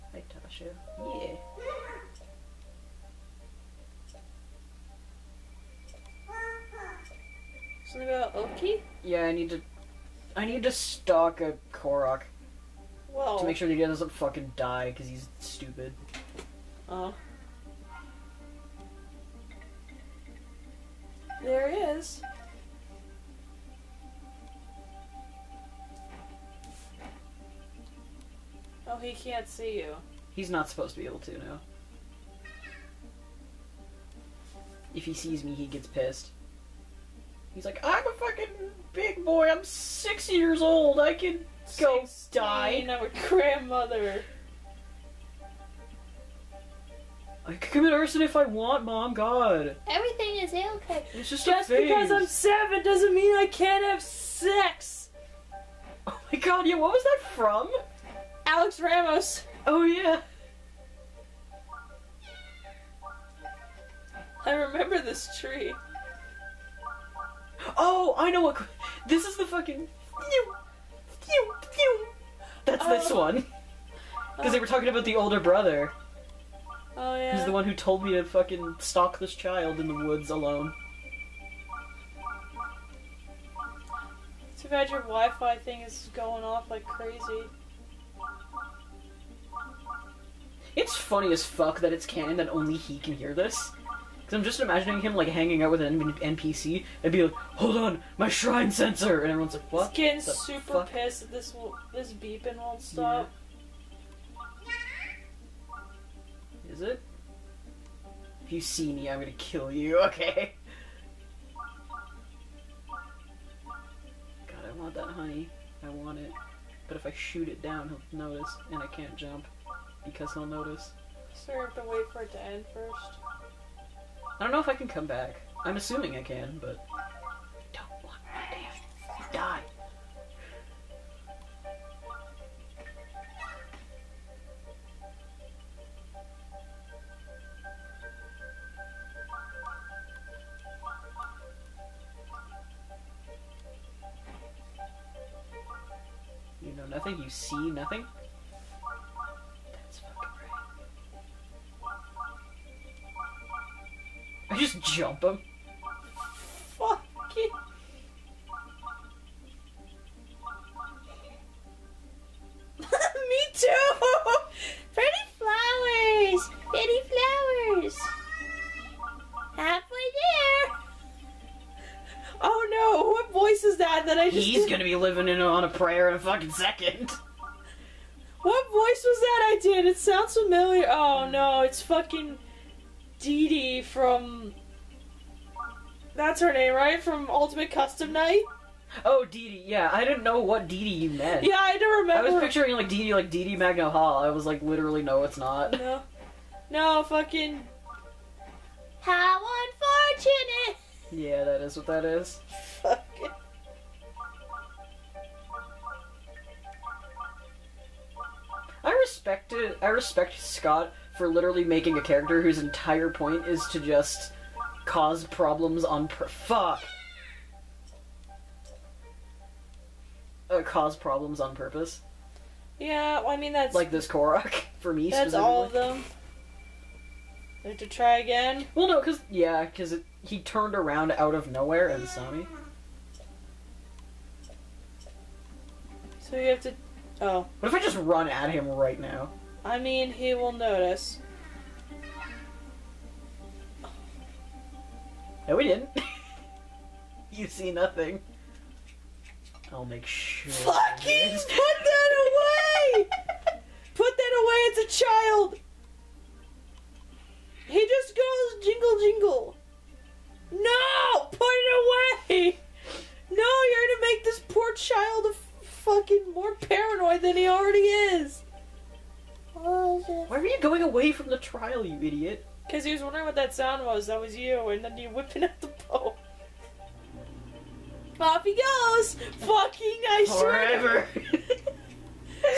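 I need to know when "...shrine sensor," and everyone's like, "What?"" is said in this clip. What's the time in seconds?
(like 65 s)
98 s.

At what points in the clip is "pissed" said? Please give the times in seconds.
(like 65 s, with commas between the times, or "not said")
35 s, 100 s.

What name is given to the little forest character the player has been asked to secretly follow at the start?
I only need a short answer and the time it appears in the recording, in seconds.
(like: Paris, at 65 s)
Oaki, at 8 s.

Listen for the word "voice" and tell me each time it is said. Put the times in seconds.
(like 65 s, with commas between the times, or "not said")
173 s, 178 s.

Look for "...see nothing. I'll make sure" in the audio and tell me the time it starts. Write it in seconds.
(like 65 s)
247 s.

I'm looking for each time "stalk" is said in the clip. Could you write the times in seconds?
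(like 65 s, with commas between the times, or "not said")
10 s, 78 s.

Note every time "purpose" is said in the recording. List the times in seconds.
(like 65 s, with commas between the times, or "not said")
216 s, 221 s.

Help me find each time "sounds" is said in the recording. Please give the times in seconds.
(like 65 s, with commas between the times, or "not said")
179 s, 273 s.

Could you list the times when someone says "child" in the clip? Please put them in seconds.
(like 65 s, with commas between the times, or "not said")
79 s, 255 s, 264 s.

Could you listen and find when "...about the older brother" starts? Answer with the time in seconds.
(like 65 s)
74 s.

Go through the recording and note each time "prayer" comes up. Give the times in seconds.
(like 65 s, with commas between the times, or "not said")
175 s.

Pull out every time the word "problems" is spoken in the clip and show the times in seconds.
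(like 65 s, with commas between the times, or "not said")
215 s, 220 s.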